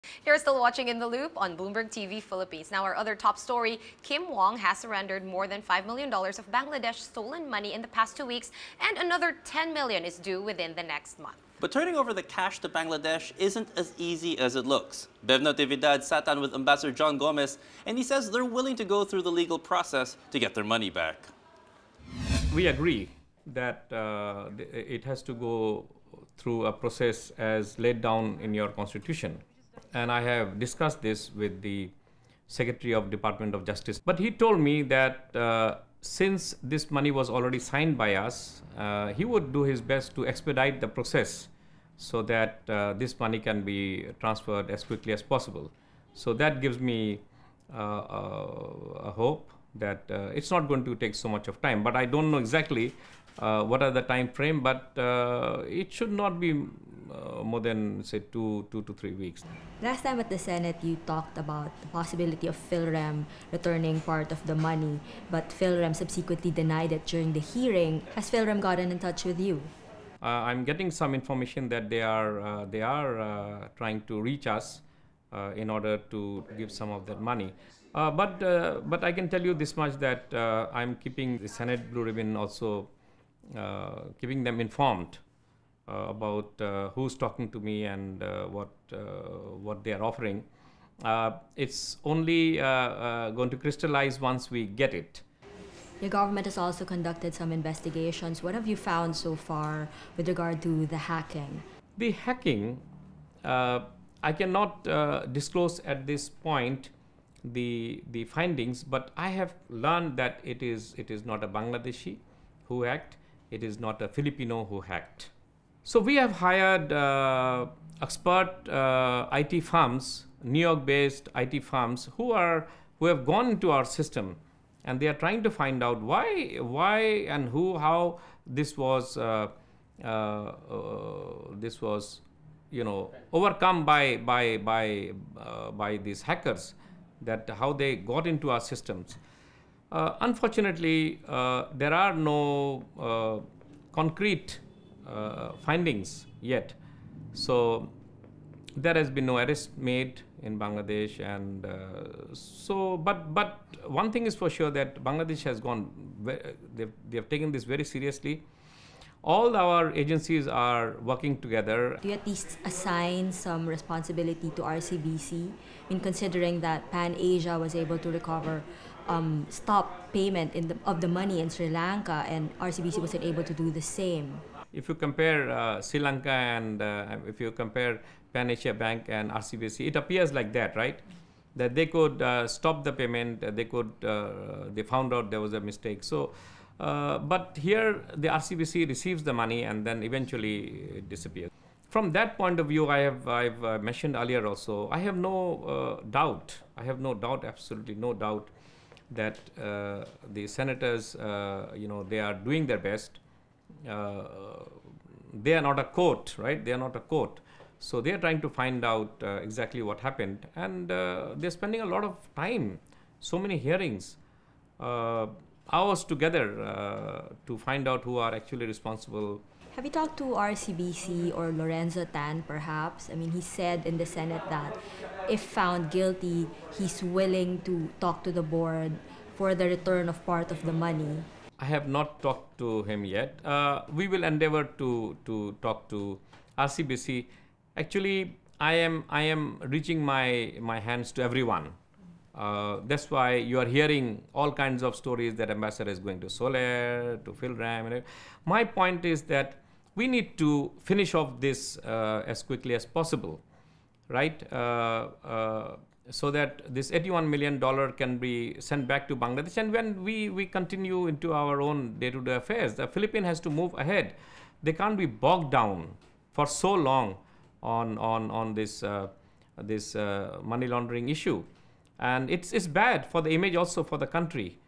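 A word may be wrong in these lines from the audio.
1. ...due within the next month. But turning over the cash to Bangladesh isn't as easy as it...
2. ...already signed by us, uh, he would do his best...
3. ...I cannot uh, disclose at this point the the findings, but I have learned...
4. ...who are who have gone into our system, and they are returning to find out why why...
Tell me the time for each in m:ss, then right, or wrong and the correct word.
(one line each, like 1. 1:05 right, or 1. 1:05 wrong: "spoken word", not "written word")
1. 0:10 right
2. 0:37 right
3. 1:44 right
4. 2:02 wrong: "trying", not "returning".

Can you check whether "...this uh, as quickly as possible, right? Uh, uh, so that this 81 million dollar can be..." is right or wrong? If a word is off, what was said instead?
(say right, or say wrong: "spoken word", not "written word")
right.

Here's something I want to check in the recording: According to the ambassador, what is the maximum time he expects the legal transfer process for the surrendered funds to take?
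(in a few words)
3 weeks.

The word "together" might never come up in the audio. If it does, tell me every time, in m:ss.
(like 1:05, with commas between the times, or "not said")
2:41, 3:36.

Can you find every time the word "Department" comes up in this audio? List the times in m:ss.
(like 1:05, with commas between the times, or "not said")
0:33.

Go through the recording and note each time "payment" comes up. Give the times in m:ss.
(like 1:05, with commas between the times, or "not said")
2:50, 3:02.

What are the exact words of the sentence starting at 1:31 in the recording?
it's only going to crystallize once we get it.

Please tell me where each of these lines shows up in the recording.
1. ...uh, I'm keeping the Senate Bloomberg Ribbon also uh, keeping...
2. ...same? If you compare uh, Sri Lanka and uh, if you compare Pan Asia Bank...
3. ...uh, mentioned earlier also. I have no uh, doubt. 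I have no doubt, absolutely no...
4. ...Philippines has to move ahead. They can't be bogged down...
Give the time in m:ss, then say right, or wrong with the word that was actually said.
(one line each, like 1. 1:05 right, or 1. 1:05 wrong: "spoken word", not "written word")
1. 1:20 wrong: "Blue", not "Bloomberg"
2. 2:53 right
3. 3:13 right
4. 4:22 right.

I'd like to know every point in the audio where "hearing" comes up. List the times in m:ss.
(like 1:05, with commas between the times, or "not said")
1:07, 3:33, 4:03.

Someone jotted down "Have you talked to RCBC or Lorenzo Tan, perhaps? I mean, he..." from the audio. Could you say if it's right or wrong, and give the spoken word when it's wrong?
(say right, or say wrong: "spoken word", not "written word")
right.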